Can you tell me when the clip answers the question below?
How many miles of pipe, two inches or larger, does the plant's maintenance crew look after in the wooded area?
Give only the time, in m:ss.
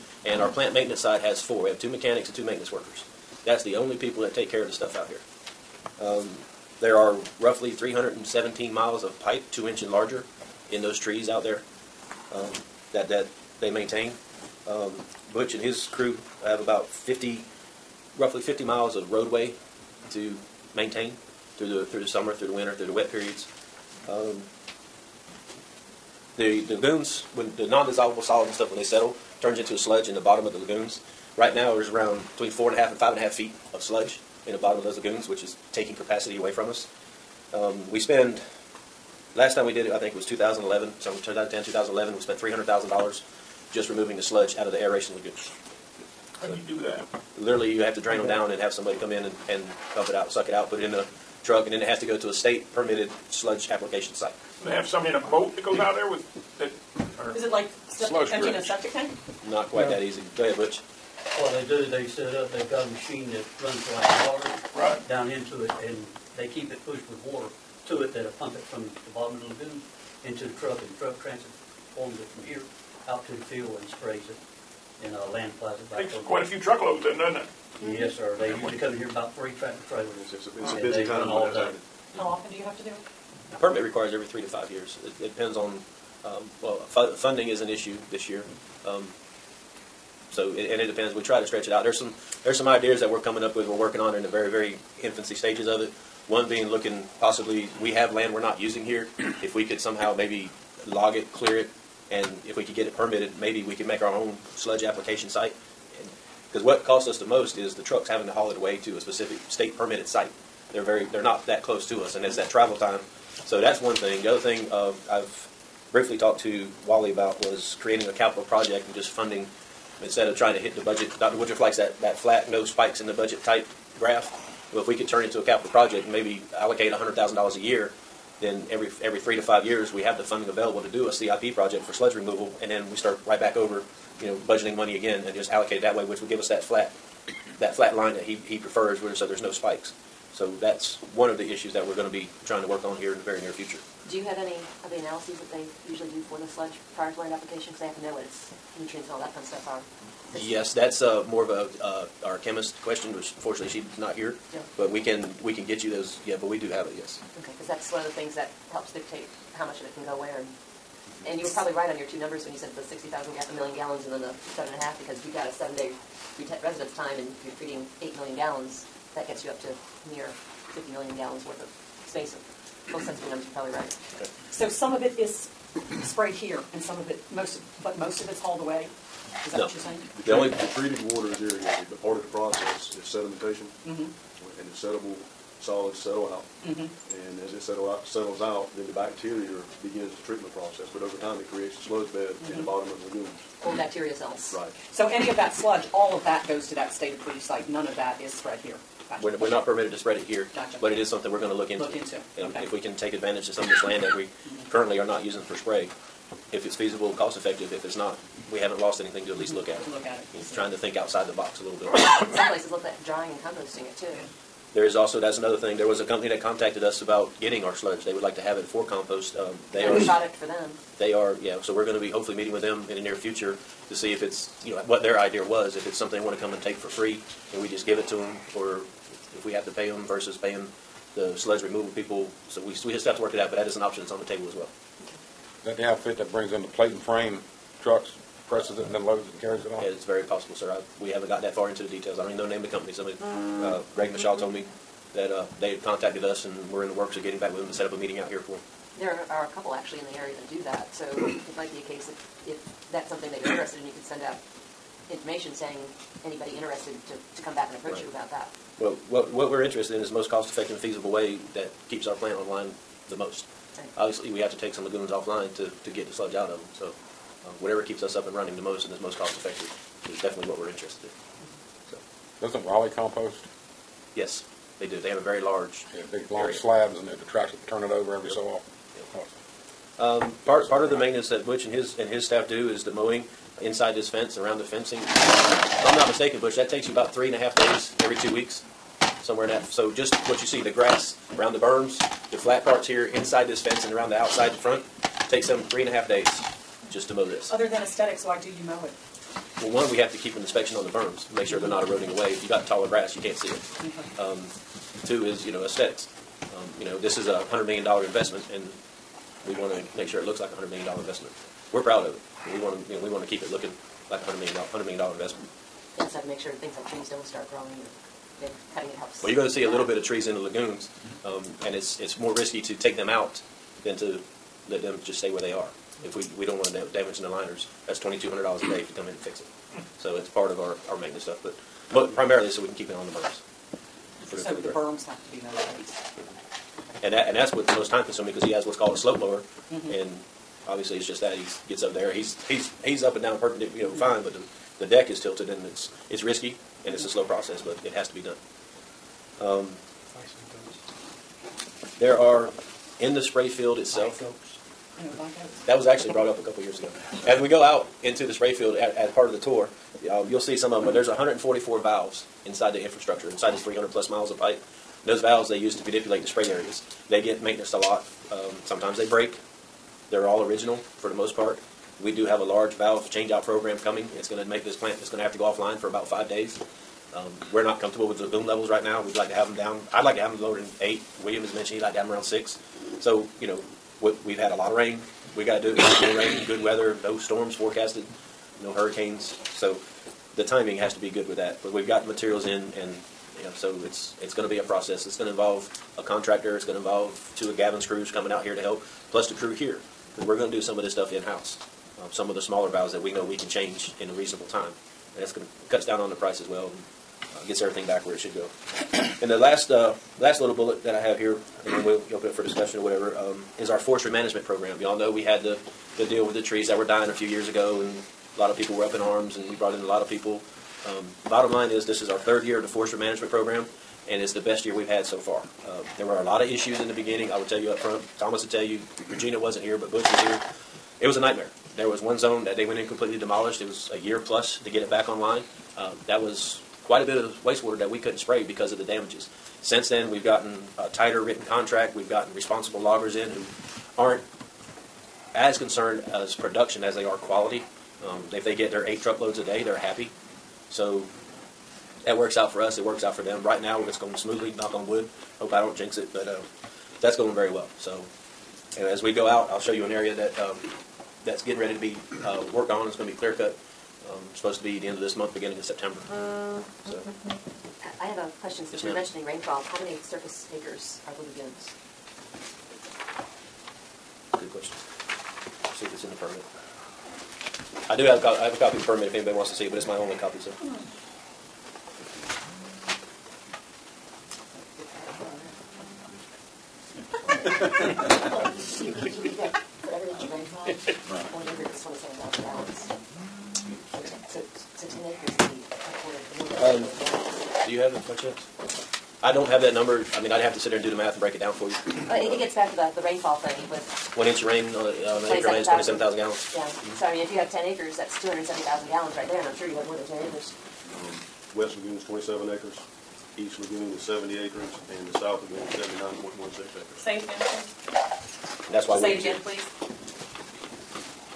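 0:07.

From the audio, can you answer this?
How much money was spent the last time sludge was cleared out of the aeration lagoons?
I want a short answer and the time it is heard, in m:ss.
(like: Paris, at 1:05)
$300,000, at 0:42.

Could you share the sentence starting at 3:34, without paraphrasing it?
There is also, that's another thing, there was a company that contacted us about getting our sludge.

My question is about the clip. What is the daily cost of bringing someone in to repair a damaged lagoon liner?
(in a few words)
$2,200.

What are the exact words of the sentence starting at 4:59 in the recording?
Well, one, we have to keep an inspection on the berms, make sure they're not eroding away.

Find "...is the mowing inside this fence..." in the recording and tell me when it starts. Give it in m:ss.
4:42.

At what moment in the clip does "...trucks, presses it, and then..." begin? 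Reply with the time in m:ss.
3:57.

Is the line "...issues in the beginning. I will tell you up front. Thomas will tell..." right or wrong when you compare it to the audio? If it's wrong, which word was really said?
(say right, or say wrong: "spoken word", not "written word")
right.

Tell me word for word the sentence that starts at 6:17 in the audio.
Um, we're not comfortable with the boom levels right now.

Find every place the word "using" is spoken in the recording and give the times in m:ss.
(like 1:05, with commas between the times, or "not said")
1:38, 3:25.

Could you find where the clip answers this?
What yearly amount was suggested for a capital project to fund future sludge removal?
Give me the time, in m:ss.
2:06.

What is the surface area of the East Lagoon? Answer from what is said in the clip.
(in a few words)
70 acres.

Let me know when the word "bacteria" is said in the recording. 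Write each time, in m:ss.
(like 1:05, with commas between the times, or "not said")
3:09, 3:13.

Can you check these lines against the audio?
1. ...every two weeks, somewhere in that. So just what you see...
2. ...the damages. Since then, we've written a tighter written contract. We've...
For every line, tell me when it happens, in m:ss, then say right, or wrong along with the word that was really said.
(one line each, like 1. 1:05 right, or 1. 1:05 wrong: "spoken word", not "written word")
1. 4:47 right
2. 7:18 wrong: "gotten", not "written".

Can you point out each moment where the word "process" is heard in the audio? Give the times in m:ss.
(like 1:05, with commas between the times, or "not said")
3:02, 3:10, 5:47, 6:34.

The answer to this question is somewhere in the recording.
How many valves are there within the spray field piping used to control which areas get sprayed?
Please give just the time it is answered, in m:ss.
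6:01.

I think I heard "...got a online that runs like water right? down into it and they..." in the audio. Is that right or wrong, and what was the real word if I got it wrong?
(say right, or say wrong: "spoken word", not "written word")
wrong: "machine", not "online".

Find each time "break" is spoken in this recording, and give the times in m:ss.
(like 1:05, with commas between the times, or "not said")
6:09, 8:21.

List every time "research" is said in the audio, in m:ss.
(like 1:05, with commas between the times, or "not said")
not said.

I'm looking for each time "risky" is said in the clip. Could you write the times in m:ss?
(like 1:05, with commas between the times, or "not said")
5:22, 5:46.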